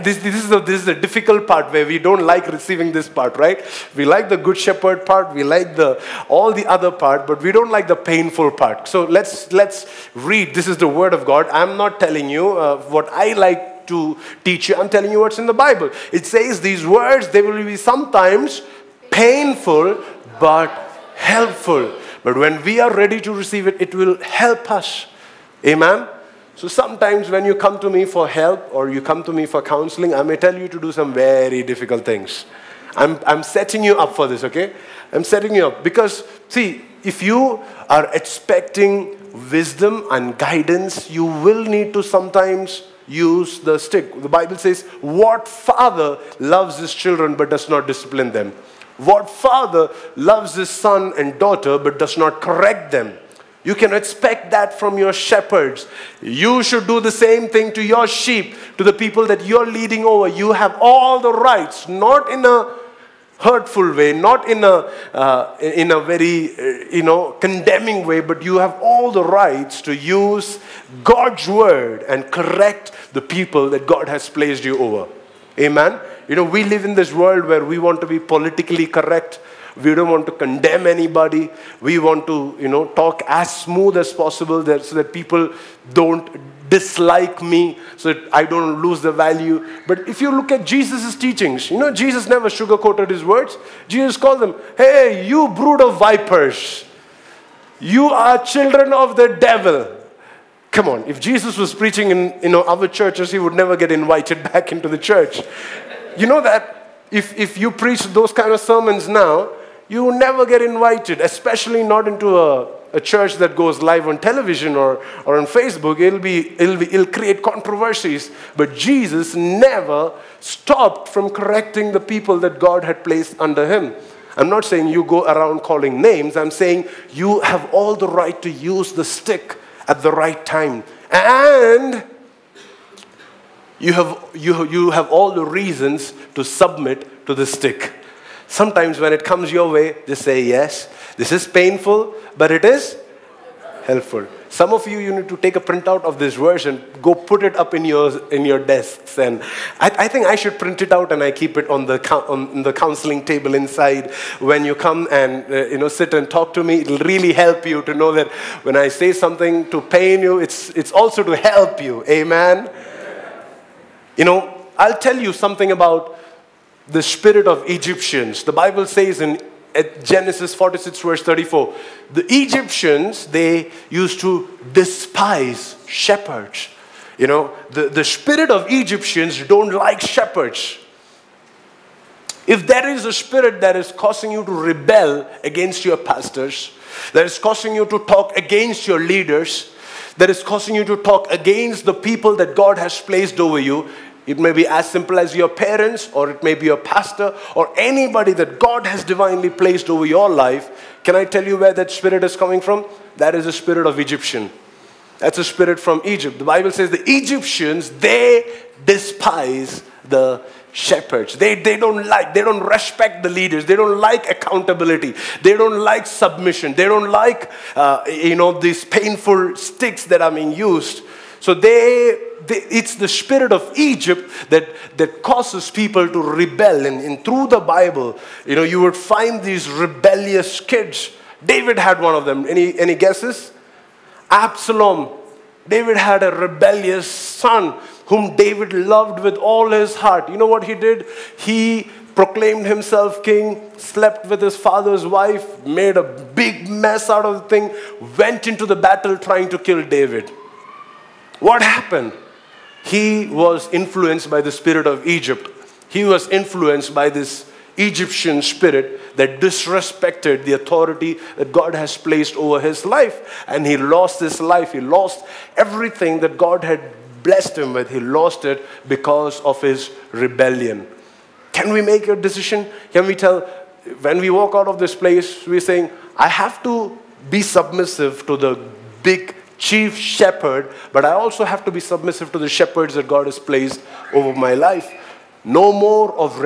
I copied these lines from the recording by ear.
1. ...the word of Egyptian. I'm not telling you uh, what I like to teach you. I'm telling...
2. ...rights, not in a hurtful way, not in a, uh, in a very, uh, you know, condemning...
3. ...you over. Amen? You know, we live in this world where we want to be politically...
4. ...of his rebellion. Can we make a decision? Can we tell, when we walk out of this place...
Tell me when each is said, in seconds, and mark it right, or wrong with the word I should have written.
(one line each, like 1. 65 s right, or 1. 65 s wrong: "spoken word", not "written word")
1. 10 s wrong: "God", not "Egyptian"
2. 61 s right
3. 74 s right
4. 269 s right.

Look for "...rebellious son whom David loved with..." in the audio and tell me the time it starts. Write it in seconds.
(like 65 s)
236 s.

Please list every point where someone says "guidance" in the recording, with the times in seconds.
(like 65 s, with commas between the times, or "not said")
40 s.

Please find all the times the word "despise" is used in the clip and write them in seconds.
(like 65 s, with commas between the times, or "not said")
174 s, 208 s.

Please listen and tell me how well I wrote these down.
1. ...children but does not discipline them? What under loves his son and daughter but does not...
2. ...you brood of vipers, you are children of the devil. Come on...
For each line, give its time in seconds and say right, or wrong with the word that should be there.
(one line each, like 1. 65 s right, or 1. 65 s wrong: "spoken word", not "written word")
1. 46 s wrong: "father", not "under"
2. 95 s right.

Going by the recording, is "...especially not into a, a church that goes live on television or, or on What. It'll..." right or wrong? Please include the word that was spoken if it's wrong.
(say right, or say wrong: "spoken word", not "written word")
wrong: "Facebook", not "What".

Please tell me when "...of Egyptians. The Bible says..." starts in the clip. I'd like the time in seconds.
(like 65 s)
167 s.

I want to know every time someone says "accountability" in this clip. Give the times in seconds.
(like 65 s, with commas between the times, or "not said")
214 s.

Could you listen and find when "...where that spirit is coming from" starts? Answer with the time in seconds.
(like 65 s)
201 s.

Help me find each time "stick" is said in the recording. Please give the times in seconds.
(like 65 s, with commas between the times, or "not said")
43 s, 129 s, 137 s, 219 s.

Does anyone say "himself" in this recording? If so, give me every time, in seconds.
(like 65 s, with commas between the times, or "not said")
242 s.